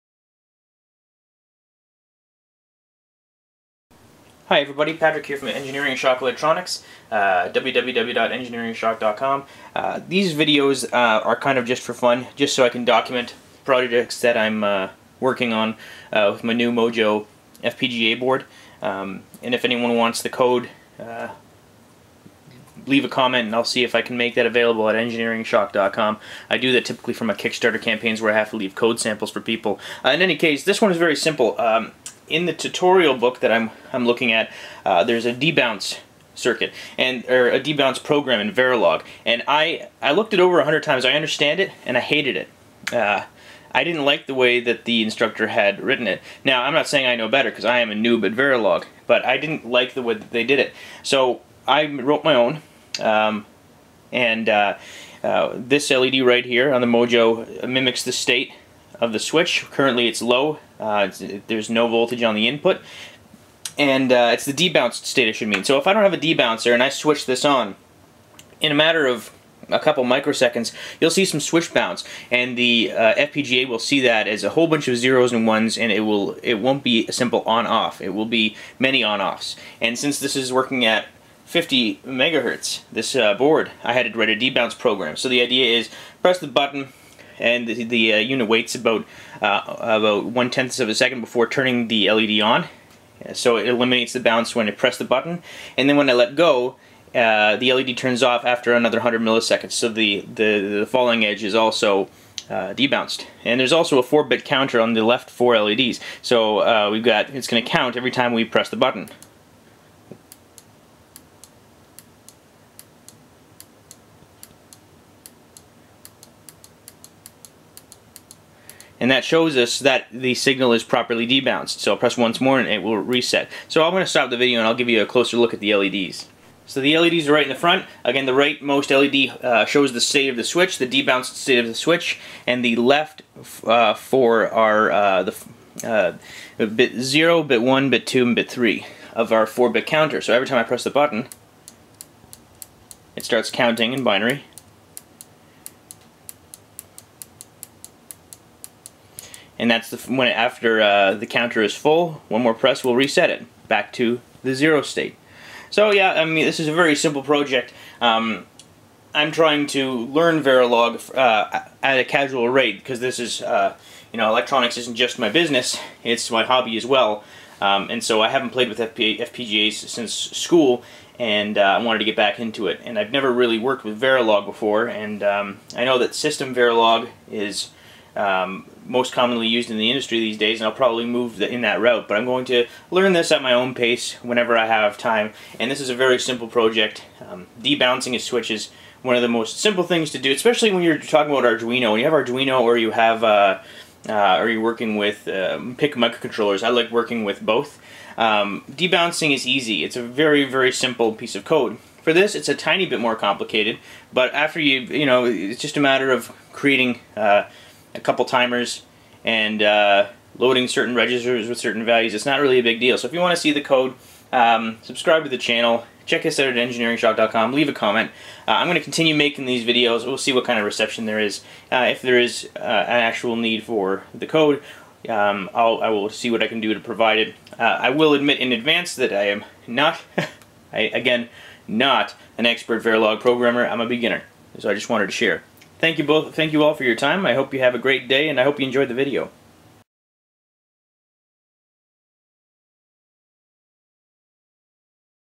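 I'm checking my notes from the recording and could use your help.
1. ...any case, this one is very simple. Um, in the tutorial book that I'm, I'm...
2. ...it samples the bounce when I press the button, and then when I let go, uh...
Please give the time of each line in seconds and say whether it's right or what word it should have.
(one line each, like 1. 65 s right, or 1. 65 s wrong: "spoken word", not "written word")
1. 30 s right
2. 93 s wrong: "eliminates", not "samples".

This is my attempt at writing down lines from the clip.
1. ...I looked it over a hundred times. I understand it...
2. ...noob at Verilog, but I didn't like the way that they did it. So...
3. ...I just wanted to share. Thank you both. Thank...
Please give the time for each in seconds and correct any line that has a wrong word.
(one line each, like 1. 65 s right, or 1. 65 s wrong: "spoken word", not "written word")
1. 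40 s right
2. 47 s right
3. 234 s right.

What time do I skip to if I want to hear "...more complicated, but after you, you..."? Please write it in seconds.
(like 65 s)
202 s.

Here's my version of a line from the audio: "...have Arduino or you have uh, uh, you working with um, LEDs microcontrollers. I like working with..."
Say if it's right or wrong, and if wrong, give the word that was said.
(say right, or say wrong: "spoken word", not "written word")
wrong: "PIC", not "LEDs".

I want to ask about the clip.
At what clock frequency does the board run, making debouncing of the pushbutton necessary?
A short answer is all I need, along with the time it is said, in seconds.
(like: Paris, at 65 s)
50 megahertz, at 81 s.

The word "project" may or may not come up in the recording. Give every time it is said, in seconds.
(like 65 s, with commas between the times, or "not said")
13 s, 157 s, 186 s.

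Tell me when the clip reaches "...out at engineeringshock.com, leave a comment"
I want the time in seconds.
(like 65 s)
216 s.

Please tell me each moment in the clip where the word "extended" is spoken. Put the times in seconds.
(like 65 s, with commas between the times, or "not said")
not said.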